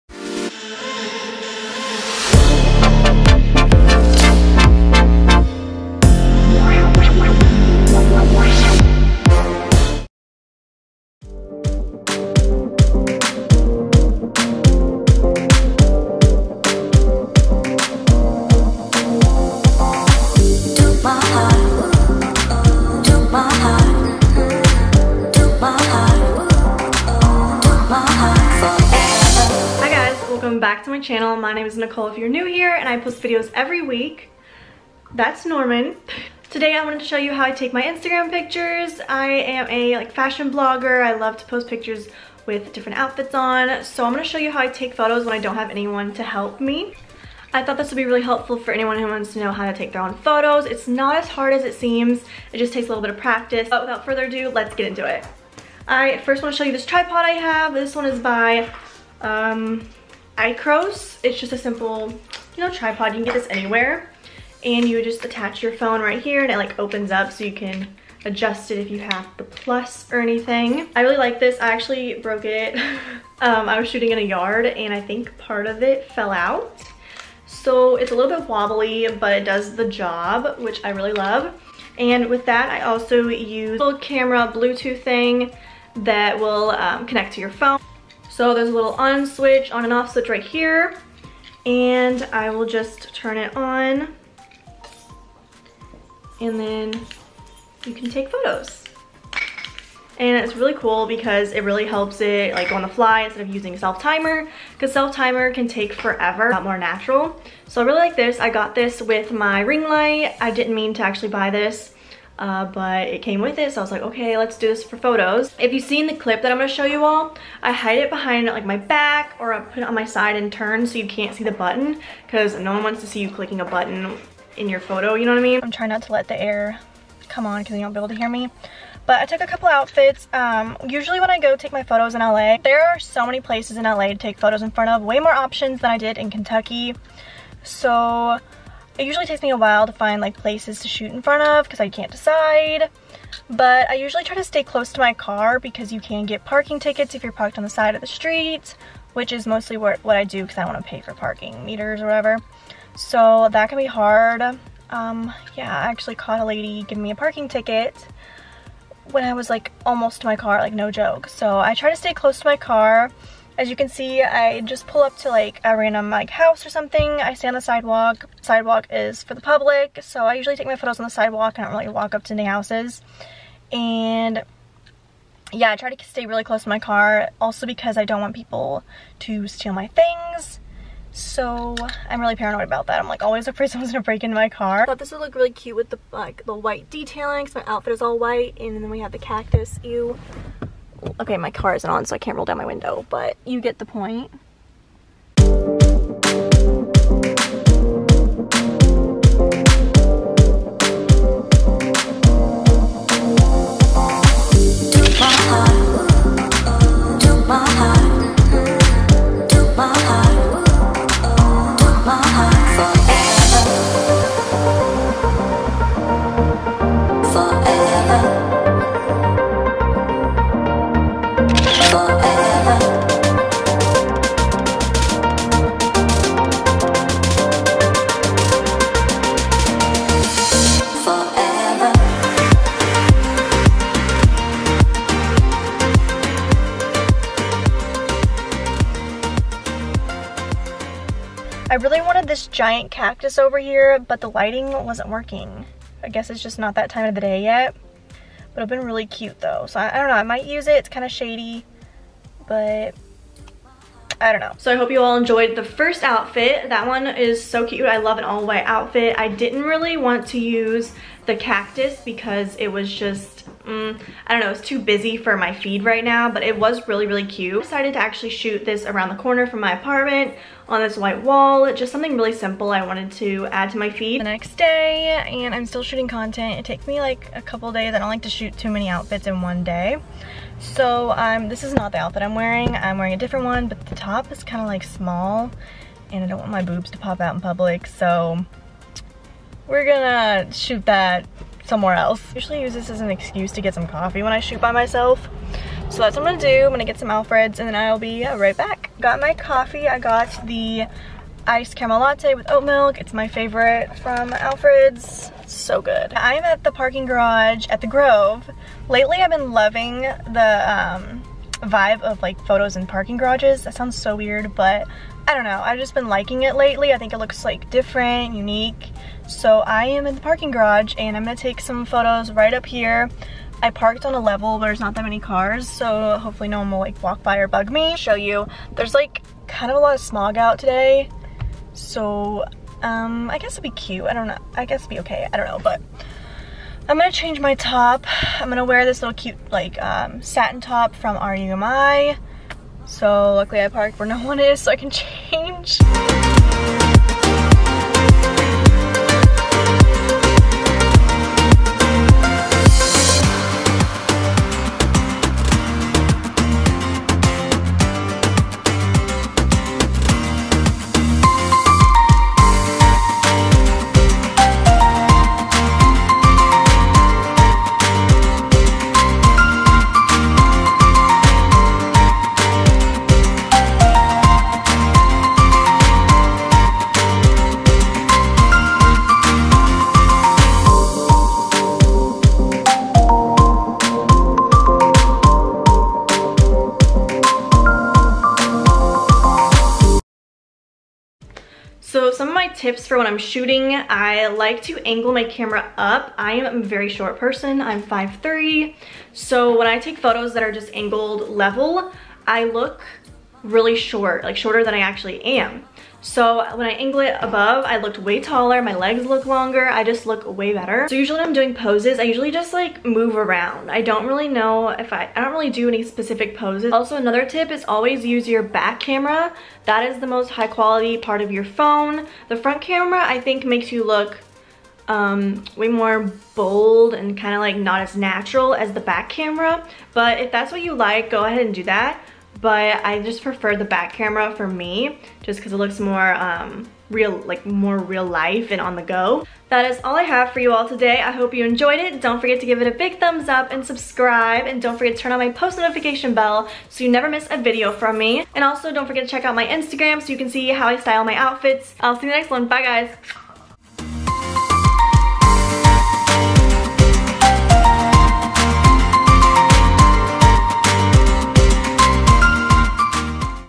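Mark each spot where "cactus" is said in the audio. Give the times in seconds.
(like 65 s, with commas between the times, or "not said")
189 s, 242 s, 261 s.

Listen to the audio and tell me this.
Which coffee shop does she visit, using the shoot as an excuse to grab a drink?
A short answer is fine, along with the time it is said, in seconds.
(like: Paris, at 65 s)
Alfred's, at 297 s.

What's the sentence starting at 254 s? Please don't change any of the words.
So I hope you all enjoyed the first outfit.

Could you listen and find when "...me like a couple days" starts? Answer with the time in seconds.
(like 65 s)
276 s.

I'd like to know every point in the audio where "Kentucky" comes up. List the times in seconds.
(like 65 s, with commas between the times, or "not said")
136 s.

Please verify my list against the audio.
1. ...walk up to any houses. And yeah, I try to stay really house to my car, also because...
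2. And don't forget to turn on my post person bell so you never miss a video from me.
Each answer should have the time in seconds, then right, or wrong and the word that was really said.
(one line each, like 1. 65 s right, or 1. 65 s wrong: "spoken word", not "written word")
1. 171 s wrong: "close", not "house"
2. 444 s wrong: "notification", not "person".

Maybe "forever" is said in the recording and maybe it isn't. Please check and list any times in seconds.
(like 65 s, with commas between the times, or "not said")
105 s.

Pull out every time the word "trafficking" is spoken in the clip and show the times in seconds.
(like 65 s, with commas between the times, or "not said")
not said.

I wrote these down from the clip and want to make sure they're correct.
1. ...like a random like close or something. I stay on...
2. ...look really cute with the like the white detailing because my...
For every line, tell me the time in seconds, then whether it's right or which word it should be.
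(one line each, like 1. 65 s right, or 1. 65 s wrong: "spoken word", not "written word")
1. 165 s wrong: "house", not "close"
2. 185 s right.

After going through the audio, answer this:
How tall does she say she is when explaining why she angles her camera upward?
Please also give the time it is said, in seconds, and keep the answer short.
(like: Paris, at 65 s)
5'3", at 397 s.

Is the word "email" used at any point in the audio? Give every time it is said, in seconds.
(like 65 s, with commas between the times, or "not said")
not said.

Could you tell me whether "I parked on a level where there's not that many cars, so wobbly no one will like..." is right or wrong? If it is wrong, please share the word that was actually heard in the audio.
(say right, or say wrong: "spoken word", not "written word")
wrong: "hopefully", not "wobbly".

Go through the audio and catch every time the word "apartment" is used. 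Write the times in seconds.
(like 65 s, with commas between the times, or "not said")
269 s.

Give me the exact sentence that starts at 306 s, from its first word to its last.
I'm at the parking garage at the Grove.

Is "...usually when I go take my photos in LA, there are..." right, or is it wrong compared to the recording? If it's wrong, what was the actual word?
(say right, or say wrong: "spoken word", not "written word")
right.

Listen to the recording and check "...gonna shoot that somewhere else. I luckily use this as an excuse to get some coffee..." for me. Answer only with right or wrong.
wrong.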